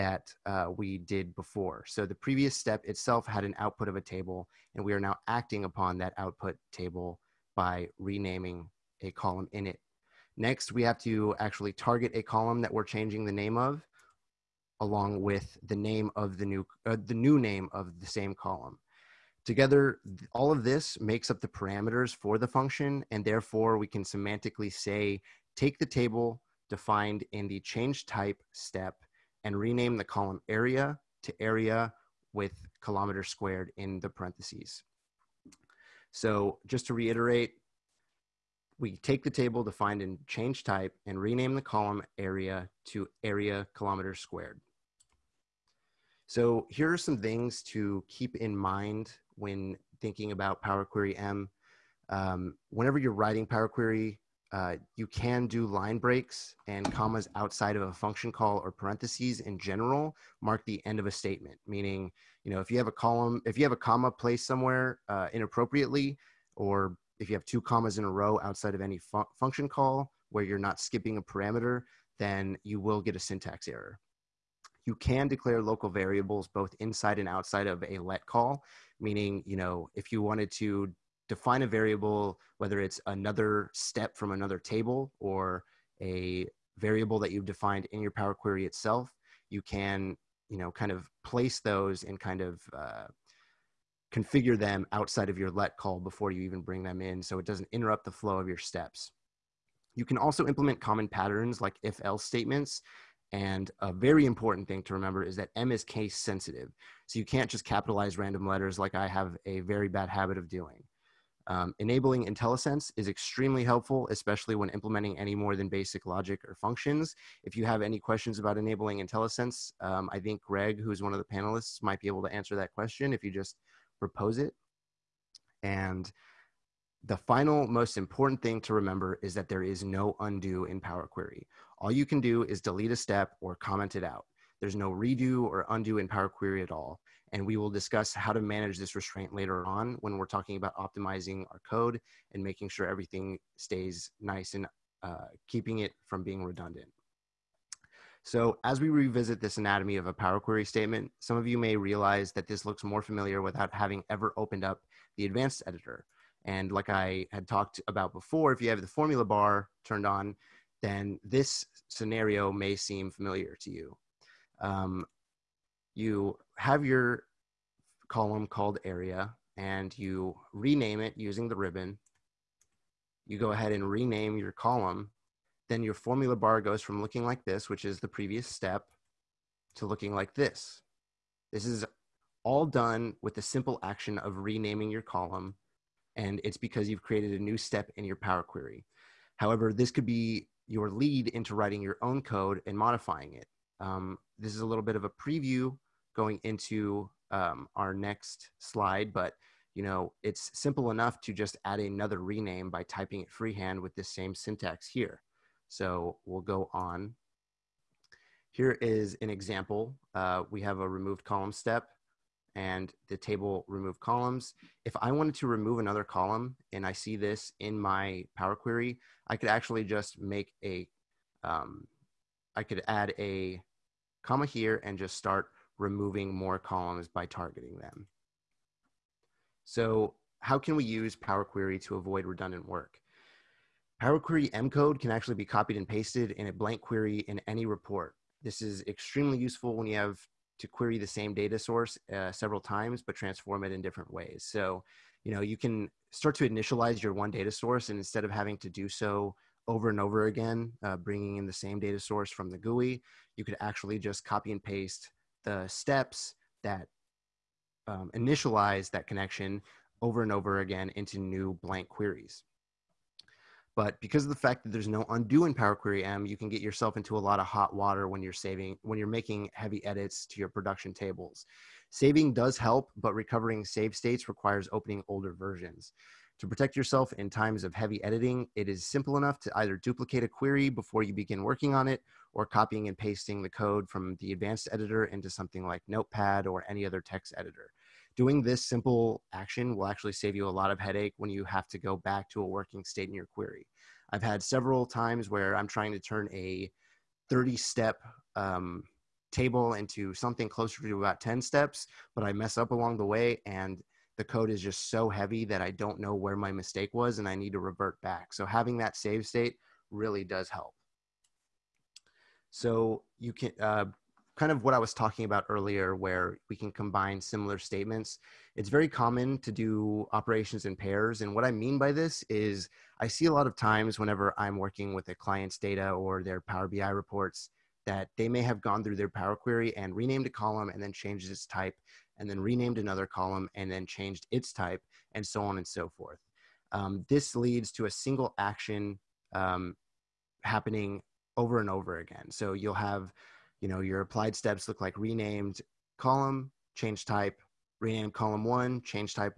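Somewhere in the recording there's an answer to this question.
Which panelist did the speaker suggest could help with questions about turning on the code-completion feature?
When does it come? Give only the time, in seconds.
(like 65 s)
120 s.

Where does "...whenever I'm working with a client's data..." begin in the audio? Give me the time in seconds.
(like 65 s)
323 s.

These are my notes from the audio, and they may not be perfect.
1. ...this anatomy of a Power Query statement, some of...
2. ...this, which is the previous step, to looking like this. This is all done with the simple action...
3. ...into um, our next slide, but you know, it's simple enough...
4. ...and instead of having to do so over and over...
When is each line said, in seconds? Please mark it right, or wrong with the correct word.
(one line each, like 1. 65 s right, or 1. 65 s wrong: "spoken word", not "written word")
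1. 149 s right
2. 177 s right
3. 196 s right
4. 247 s right.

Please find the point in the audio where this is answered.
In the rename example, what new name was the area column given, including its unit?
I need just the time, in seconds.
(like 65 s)
43 s.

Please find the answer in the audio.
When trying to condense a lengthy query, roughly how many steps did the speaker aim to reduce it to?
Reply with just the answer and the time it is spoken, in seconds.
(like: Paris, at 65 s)
10, at 301 s.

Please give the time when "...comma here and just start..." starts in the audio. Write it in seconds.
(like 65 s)
224 s.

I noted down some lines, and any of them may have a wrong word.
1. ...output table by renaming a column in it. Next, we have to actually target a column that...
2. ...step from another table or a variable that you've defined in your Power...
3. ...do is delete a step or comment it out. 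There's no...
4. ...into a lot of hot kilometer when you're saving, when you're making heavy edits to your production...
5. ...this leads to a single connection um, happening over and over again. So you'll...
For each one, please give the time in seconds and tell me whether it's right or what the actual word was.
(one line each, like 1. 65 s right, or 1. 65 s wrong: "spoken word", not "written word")
1. 6 s right
2. 83 s right
3. 132 s right
4. 266 s wrong: "water", not "kilometer"
5. 337 s wrong: "action", not "connection".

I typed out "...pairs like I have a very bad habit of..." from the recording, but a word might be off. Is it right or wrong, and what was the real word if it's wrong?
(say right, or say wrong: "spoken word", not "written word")
wrong: "letters", not "pairs".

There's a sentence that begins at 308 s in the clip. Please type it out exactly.
So having that save state really does help.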